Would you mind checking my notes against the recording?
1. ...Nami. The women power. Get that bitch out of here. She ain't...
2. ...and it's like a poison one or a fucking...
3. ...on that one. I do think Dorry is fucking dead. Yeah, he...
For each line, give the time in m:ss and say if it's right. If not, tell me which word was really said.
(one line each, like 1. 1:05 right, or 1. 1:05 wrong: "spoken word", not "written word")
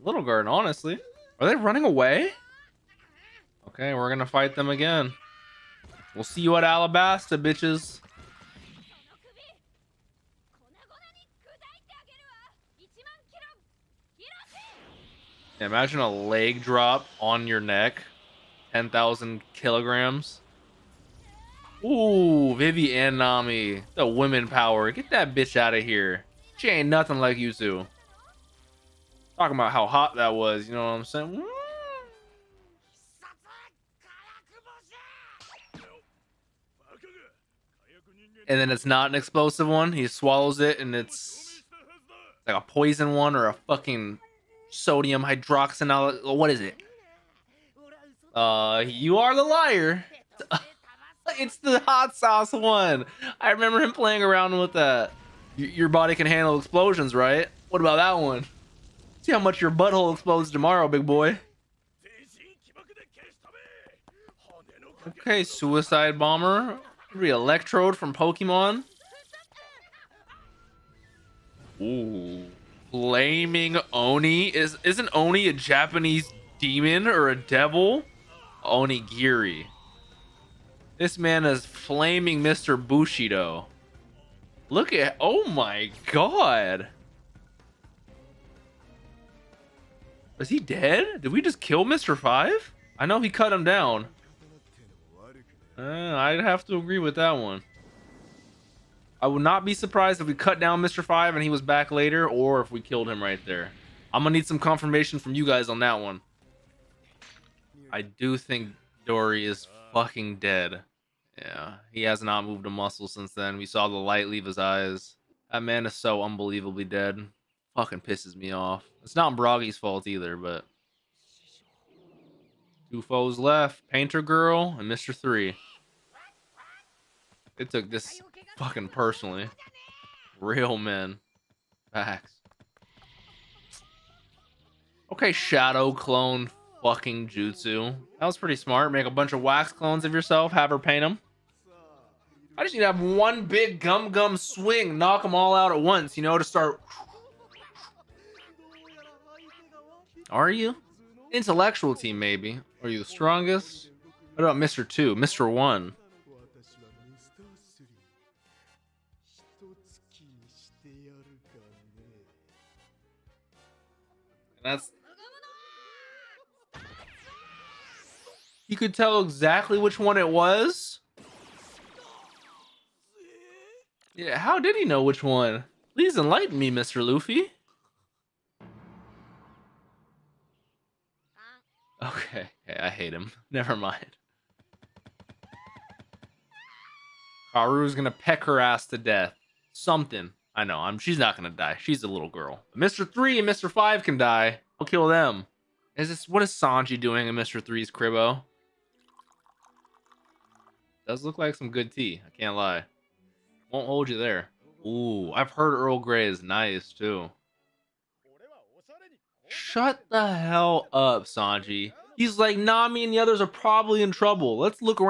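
1. 0:23 right
2. 0:40 right
3. 1:45 right.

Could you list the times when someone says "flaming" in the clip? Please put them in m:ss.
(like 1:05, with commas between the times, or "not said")
1:12, 1:21.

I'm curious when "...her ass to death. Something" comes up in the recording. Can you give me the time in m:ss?
3:08.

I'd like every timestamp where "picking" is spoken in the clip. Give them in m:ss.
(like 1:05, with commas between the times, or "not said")
not said.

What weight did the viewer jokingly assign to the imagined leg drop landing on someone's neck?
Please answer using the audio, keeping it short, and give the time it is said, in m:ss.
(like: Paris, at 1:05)
10,000 kilograms, at 0:18.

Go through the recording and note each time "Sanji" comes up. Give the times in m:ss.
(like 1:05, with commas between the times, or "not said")
3:16, 3:31.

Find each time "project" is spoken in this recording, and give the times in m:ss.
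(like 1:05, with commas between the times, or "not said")
not said.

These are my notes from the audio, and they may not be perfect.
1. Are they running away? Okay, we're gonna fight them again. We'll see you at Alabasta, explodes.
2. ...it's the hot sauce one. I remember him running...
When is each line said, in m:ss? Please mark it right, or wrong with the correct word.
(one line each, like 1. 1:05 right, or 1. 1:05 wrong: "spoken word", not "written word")
1. 0:01 wrong: "bitches", not "explodes"
2. 0:51 wrong: "playing", not "running".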